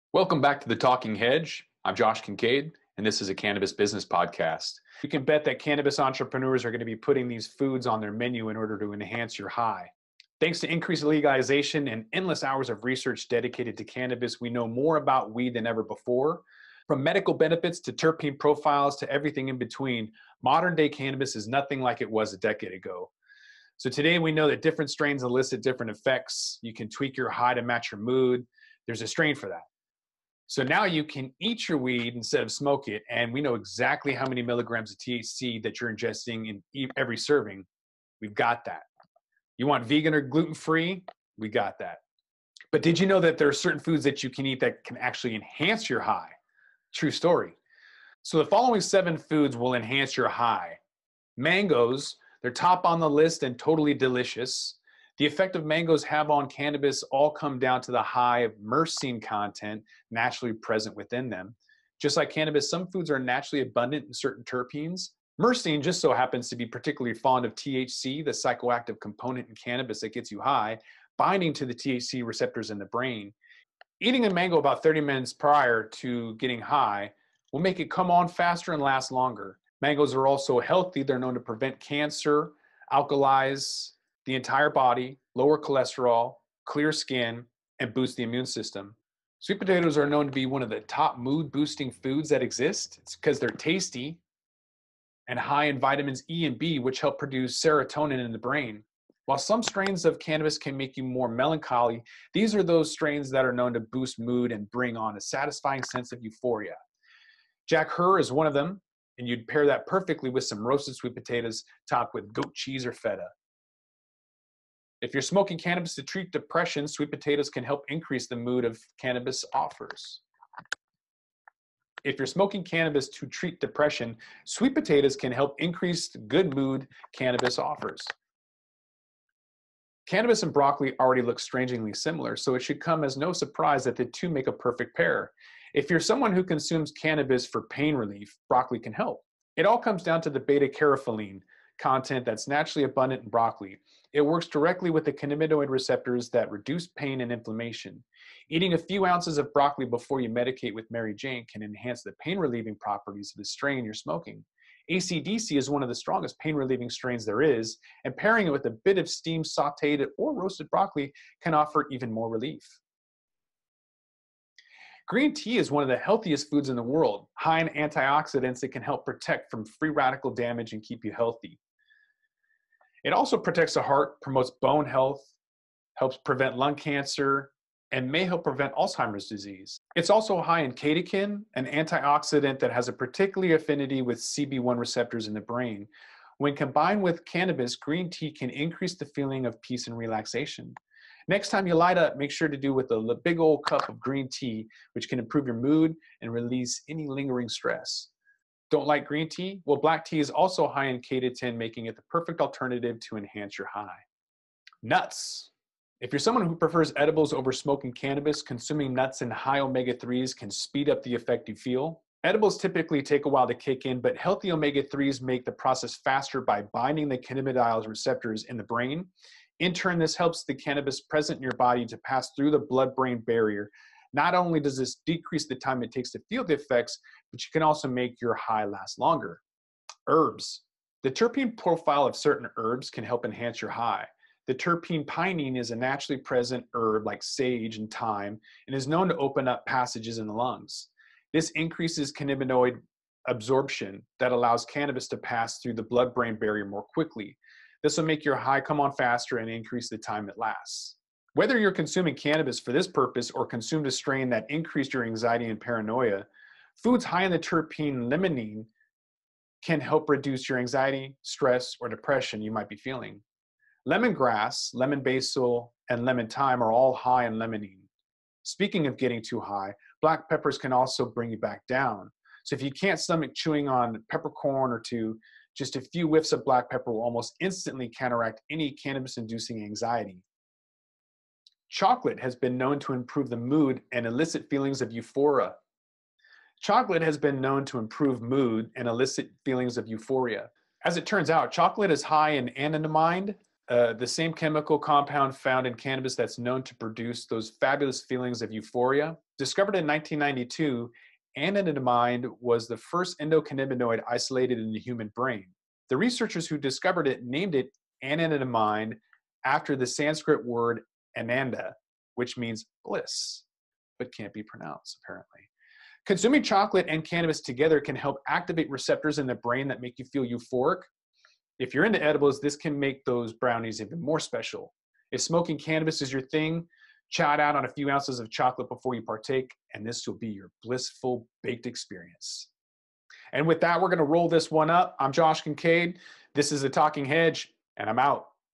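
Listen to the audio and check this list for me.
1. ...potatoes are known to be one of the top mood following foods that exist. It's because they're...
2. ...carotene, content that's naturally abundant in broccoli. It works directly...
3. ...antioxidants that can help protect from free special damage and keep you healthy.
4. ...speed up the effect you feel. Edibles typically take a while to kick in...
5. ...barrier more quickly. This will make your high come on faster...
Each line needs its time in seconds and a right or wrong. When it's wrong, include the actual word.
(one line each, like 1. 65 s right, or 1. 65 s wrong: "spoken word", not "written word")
1. 89 s wrong: "boosting", not "following"
2. 140 s right
3. 167 s wrong: "radical", not "special"
4. 210 s right
5. 246 s right.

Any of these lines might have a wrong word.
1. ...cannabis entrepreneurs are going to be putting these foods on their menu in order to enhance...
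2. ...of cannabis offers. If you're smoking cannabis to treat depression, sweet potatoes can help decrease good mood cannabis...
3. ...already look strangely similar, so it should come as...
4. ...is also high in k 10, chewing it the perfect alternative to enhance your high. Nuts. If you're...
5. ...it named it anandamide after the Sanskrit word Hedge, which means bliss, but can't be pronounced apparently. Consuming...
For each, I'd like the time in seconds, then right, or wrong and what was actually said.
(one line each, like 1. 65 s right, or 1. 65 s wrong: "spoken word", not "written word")
1. 5 s right
2. 118 s wrong: "increase", not "decrease"
3. 130 s right
4. 200 s wrong: "making", not "chewing"
5. 307 s wrong: "Ananda", not "Hedge".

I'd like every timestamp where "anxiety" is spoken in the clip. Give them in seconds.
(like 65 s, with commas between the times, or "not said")
255 s, 260 s, 279 s.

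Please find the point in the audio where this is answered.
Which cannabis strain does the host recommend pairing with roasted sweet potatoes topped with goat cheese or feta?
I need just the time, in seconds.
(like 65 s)
107 s.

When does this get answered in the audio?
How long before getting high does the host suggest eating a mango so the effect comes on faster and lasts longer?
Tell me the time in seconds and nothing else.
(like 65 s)
74 s.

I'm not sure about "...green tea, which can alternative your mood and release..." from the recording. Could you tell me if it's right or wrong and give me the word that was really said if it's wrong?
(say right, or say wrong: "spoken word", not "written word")
wrong: "improve", not "alternative".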